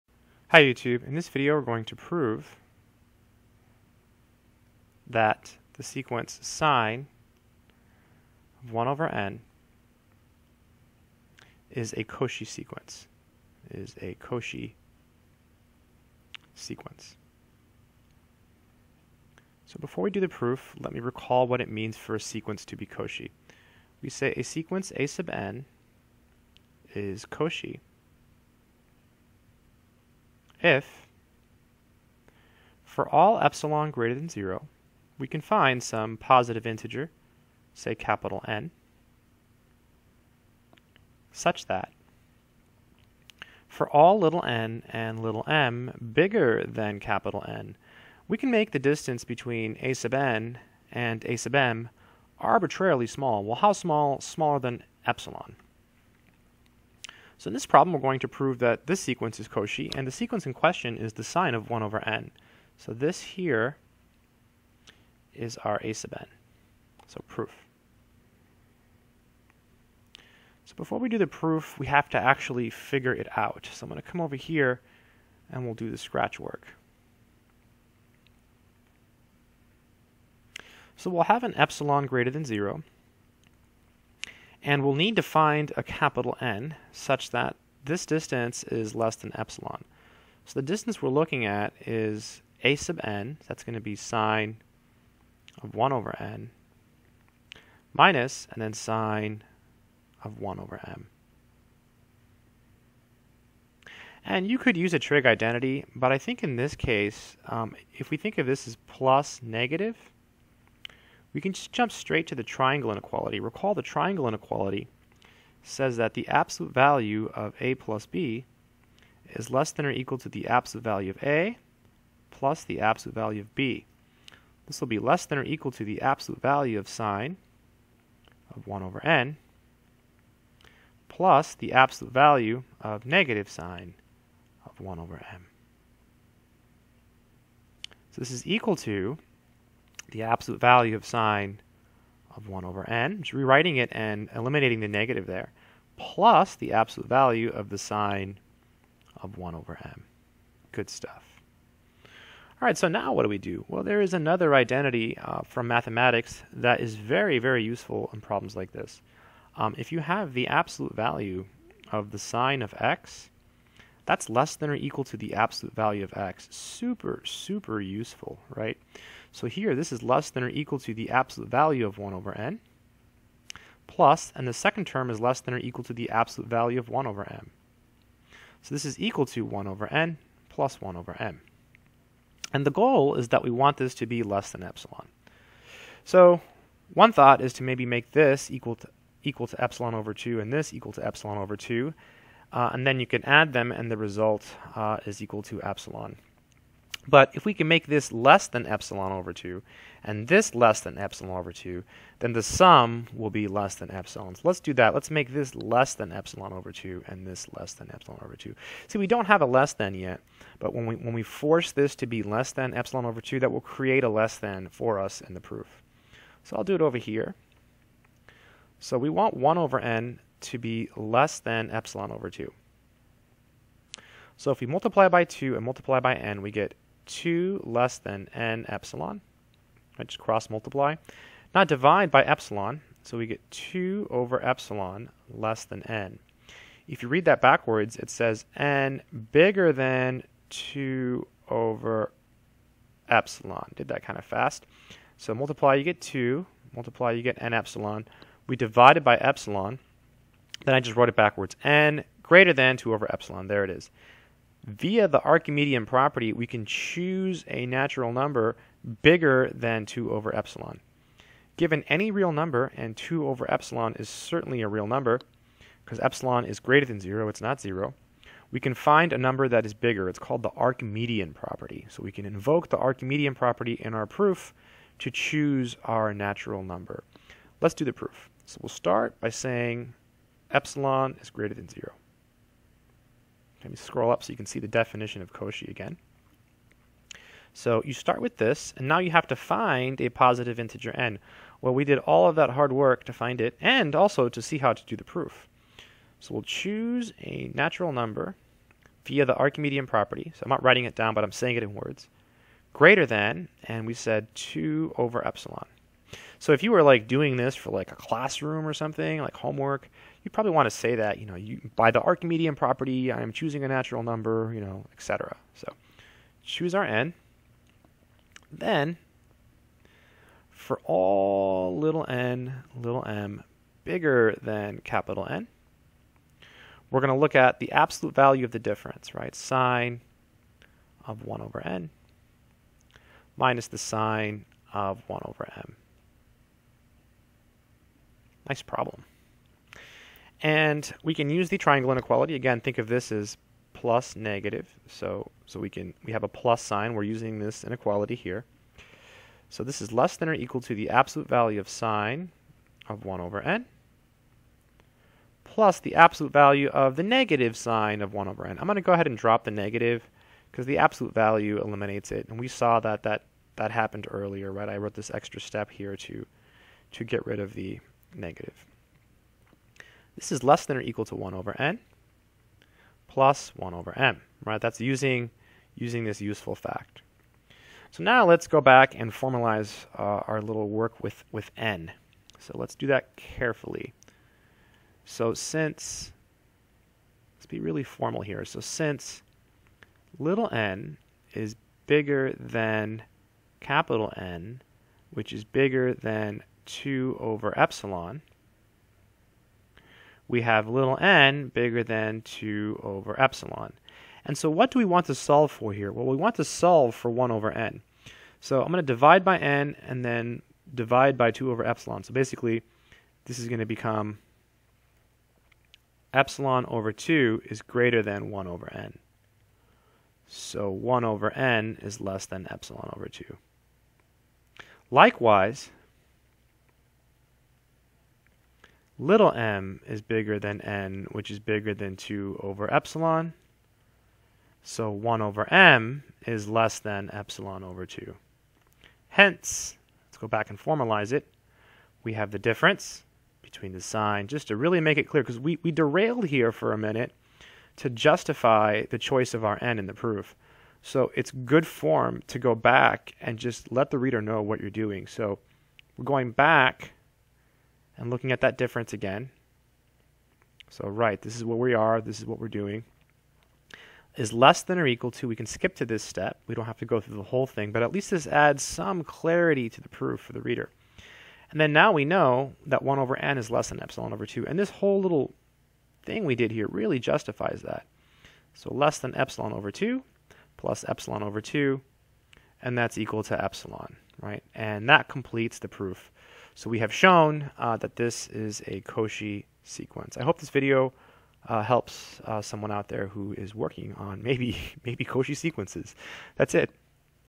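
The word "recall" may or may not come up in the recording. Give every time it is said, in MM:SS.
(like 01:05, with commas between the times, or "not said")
00:20, 01:53.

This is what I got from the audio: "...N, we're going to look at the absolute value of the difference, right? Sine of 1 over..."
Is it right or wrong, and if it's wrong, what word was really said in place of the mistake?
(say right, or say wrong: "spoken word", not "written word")
right.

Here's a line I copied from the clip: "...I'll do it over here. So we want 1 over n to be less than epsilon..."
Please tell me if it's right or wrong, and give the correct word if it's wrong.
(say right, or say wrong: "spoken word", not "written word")
right.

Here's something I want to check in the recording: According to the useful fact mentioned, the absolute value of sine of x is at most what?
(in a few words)
absolute value of x.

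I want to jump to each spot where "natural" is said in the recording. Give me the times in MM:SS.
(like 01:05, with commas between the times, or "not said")
04:17, 04:36, 04:57, 05:13.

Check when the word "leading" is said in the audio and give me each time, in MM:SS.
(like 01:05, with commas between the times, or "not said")
not said.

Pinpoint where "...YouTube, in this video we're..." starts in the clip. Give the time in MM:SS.
00:00.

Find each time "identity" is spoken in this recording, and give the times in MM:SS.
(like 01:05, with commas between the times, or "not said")
01:45, 02:34.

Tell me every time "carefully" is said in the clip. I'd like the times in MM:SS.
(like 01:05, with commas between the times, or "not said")
06:23.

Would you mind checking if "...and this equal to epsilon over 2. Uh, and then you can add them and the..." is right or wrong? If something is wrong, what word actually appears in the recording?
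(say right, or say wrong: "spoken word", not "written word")
right.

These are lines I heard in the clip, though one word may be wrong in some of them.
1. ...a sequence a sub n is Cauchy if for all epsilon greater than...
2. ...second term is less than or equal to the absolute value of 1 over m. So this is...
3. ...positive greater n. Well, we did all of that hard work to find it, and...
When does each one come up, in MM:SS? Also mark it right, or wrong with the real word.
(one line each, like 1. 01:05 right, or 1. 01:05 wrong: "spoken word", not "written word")
1. 00:24 right
2. 02:54 right
3. 04:50 wrong: "integer", not "greater".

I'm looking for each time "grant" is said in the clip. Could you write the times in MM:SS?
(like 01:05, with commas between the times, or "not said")
not said.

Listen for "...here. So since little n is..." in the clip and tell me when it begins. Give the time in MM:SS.
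06:28.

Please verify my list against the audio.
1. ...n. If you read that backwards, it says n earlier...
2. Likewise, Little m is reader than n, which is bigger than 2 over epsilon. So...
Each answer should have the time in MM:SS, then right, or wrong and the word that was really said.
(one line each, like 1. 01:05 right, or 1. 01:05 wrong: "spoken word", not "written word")
1. 03:55 wrong: "bigger", not "earlier"
2. 07:04 wrong: "bigger", not "reader".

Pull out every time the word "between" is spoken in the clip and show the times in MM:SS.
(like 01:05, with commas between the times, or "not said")
00:49, 07:23.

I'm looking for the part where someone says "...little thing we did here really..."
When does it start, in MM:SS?
07:54.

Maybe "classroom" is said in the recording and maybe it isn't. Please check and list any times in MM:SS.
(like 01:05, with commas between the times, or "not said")
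05:07.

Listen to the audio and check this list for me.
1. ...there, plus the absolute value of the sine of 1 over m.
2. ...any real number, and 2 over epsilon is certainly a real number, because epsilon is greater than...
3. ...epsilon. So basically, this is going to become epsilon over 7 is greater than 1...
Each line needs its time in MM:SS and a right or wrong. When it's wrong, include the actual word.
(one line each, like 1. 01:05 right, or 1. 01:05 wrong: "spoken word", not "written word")
1. 02:25 right
2. 04:21 right
3. 06:51 wrong: "2", not "7".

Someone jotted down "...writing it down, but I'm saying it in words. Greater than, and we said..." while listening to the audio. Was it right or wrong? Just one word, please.
right.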